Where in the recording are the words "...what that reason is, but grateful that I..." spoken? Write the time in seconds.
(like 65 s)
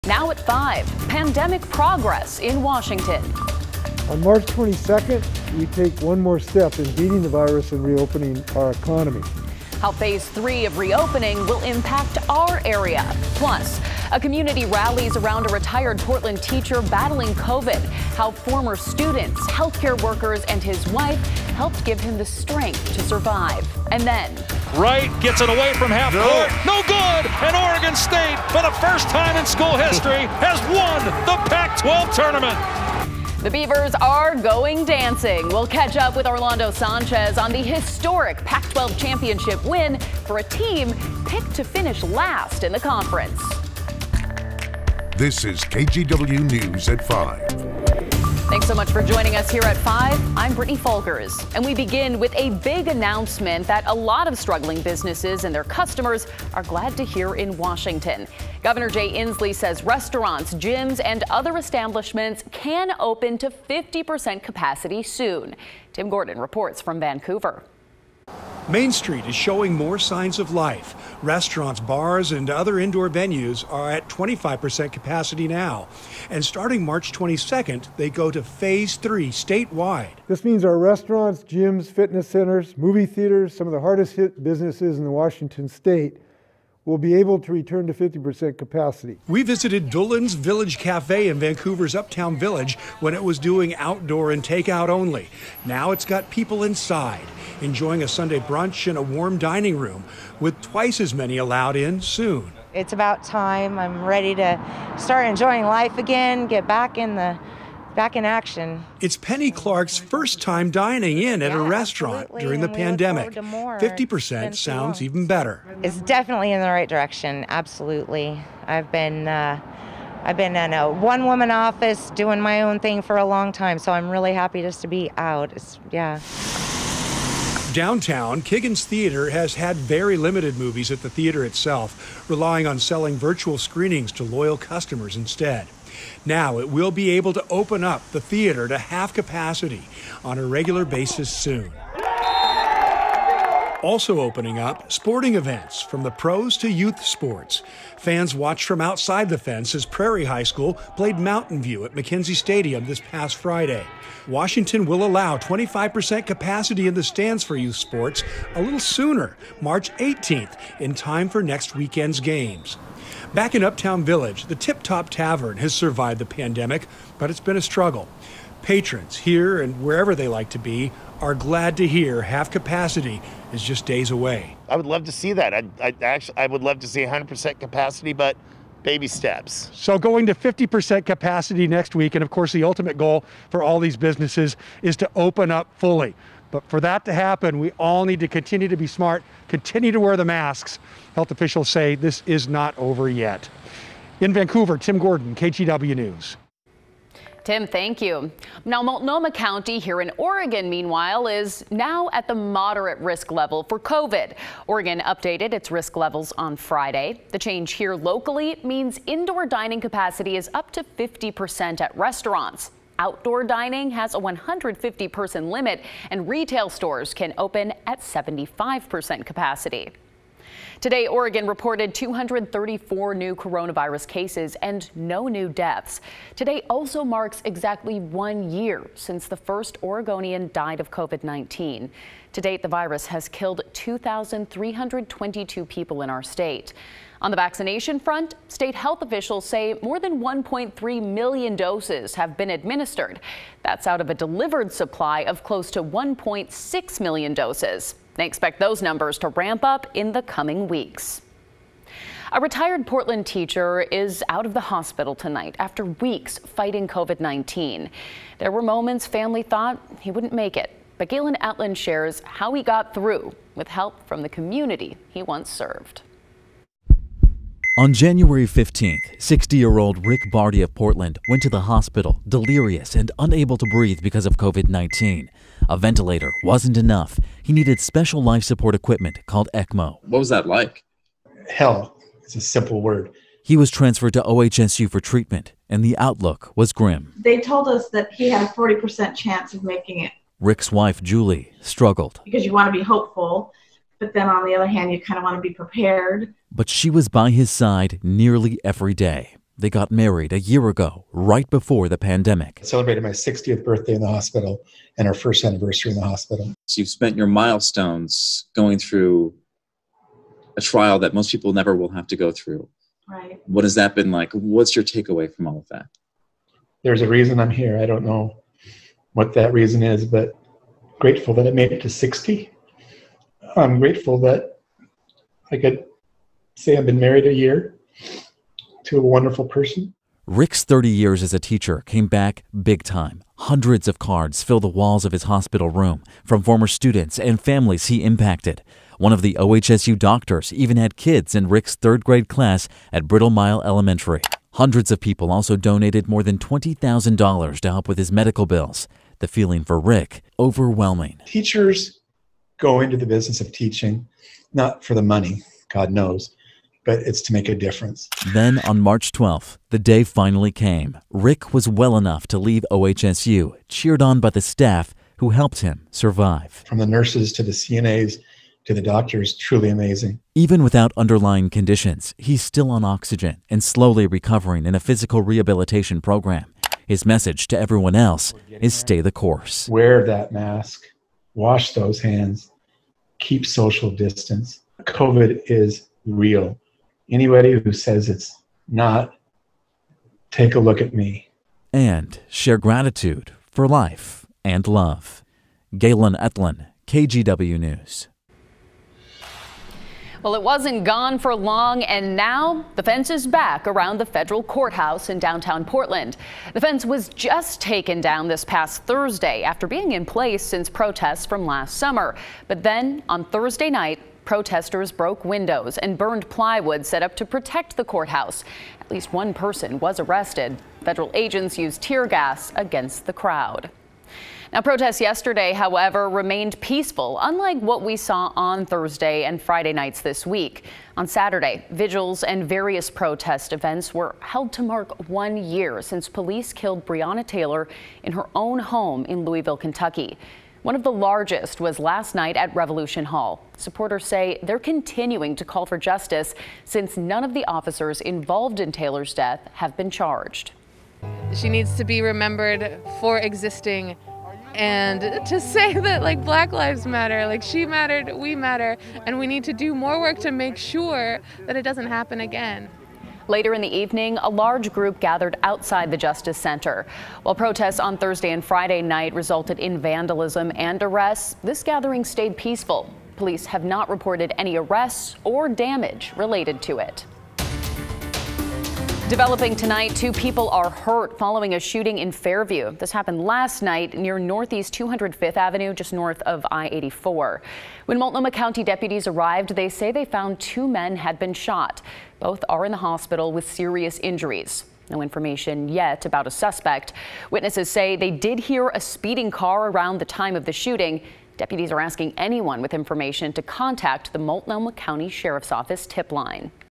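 319 s.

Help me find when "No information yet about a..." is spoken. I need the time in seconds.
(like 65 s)
494 s.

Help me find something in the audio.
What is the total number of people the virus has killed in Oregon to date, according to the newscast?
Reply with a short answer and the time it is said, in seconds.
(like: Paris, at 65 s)
2,322, at 233 s.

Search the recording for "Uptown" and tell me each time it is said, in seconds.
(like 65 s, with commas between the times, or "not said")
91 s, 163 s.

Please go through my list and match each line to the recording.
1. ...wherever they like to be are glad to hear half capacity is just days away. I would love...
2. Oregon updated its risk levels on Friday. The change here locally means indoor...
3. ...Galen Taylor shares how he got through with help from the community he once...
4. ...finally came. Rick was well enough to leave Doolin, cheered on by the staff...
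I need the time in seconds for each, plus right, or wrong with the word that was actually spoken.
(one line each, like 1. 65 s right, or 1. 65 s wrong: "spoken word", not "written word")
1. 169 s right
2. 204 s right
3. 261 s wrong: "Ettlin", not "Taylor"
4. 360 s wrong: "OHSU", not "Doolin".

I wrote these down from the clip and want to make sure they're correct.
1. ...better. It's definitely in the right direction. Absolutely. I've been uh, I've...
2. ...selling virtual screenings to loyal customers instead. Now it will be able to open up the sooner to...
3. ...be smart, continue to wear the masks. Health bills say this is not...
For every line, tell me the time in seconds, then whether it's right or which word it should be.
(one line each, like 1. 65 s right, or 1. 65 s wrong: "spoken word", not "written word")
1. 115 s right
2. 132 s wrong: "theater", not "sooner"
3. 188 s wrong: "officials", not "bills".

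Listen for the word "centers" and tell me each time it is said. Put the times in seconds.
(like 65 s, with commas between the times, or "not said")
82 s, 466 s.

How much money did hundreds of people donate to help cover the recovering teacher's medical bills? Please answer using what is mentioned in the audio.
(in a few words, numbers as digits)
More than $20,000.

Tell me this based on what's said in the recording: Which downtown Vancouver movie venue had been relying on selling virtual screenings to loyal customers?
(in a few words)
Kiggins Theater.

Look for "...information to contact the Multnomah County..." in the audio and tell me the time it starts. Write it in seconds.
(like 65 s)
502 s.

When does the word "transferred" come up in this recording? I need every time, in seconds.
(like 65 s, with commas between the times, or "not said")
283 s.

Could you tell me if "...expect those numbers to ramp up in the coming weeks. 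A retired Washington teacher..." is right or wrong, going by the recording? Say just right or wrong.
wrong.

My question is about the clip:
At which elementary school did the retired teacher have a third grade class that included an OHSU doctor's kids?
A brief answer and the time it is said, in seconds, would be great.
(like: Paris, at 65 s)
Bridlemile Elementary, at 343 s.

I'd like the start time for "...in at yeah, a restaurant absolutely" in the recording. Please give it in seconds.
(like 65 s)
111 s.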